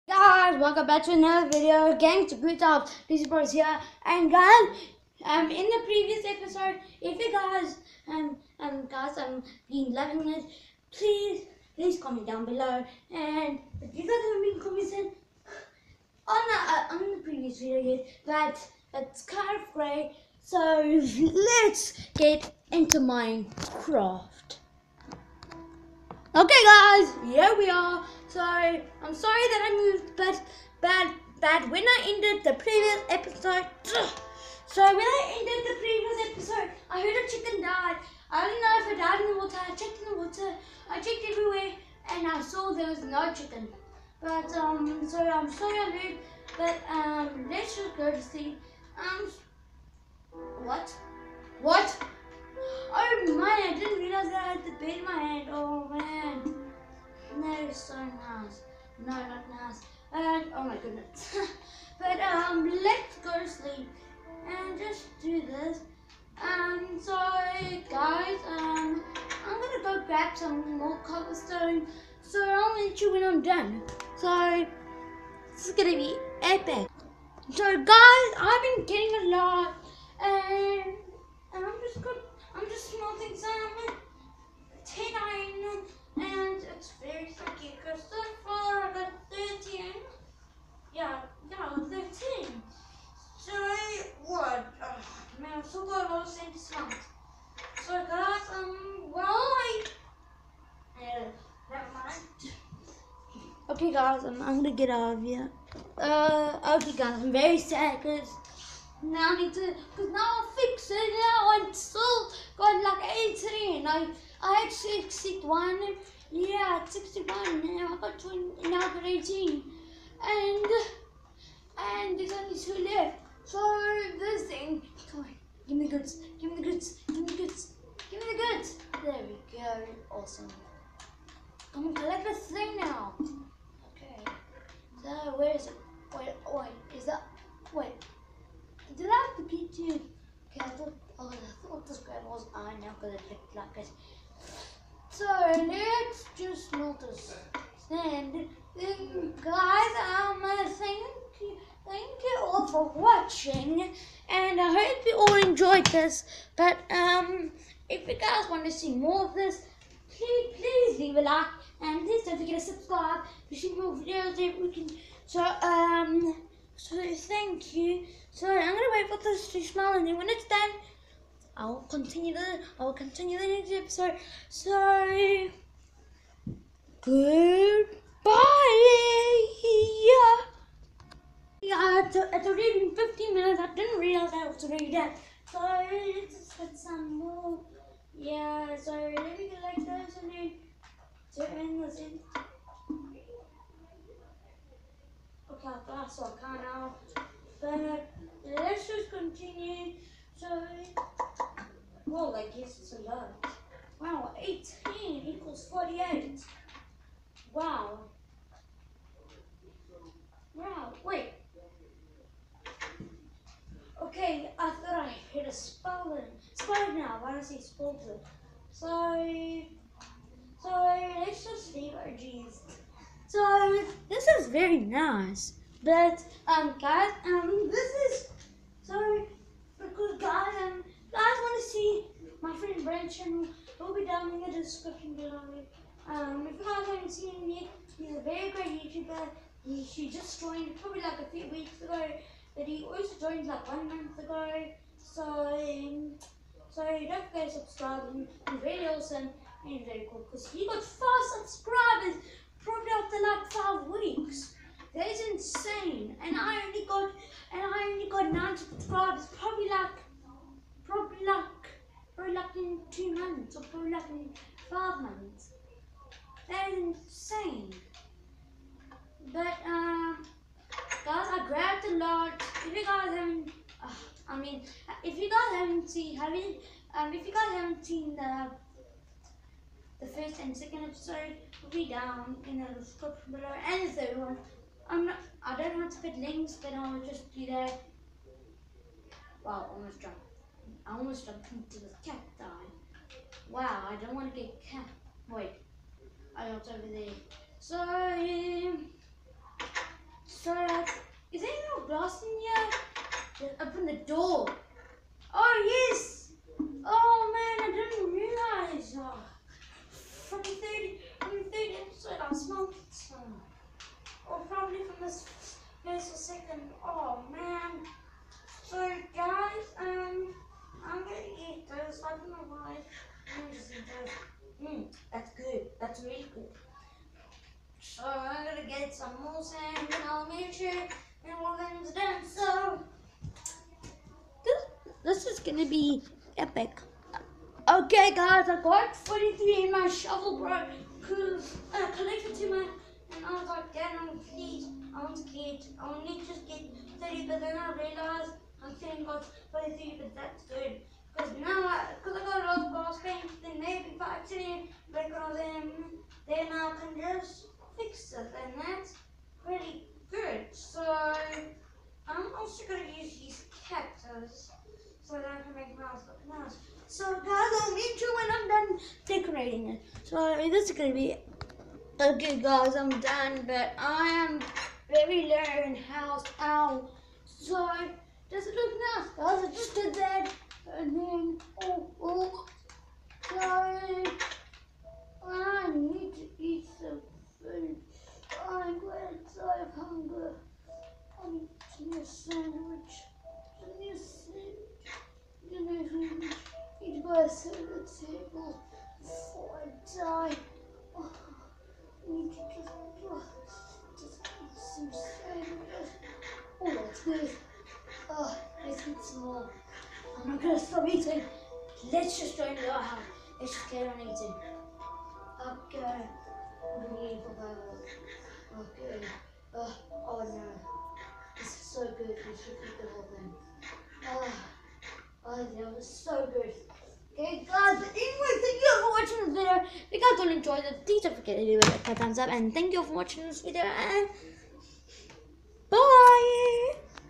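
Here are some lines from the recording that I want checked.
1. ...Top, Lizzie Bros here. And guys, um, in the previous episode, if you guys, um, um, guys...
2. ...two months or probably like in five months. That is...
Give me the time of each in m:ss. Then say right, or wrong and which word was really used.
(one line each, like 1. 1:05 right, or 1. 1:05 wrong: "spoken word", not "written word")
1. 0:02 right
2. 4:22 right.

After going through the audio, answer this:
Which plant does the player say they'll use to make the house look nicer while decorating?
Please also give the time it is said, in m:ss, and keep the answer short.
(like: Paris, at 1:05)
cactus, at 6:03.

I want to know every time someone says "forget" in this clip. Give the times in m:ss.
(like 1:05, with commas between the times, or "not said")
2:42, 4:07, 7:11.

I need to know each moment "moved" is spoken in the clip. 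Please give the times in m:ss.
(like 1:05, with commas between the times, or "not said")
0:29, 0:45.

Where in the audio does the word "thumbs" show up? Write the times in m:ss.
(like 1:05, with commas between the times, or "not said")
7:11.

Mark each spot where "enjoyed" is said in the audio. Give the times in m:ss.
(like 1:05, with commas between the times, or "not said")
2:35, 7:10.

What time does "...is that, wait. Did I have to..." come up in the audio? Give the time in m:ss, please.
2:16.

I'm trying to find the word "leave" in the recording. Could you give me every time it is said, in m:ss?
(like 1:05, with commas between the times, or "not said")
2:40, 3:41.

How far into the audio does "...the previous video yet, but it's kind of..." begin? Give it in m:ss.
0:17.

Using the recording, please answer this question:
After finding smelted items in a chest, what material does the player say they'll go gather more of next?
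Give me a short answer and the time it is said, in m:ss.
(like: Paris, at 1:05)
sand, at 5:29.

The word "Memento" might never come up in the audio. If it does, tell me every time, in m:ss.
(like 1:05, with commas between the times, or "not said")
not said.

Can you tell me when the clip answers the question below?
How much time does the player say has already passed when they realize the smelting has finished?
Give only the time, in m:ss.
3:02.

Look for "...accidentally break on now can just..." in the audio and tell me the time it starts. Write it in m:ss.
5:54.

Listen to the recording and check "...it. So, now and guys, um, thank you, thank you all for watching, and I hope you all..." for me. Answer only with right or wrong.
right.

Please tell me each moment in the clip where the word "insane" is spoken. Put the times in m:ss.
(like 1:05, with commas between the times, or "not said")
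4:15, 4:26.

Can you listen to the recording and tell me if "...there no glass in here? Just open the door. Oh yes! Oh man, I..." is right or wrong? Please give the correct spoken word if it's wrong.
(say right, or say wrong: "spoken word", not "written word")
right.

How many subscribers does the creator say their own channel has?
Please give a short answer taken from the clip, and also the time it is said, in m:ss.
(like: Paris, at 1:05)
9, at 4:18.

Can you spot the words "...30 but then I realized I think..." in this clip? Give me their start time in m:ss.
5:47.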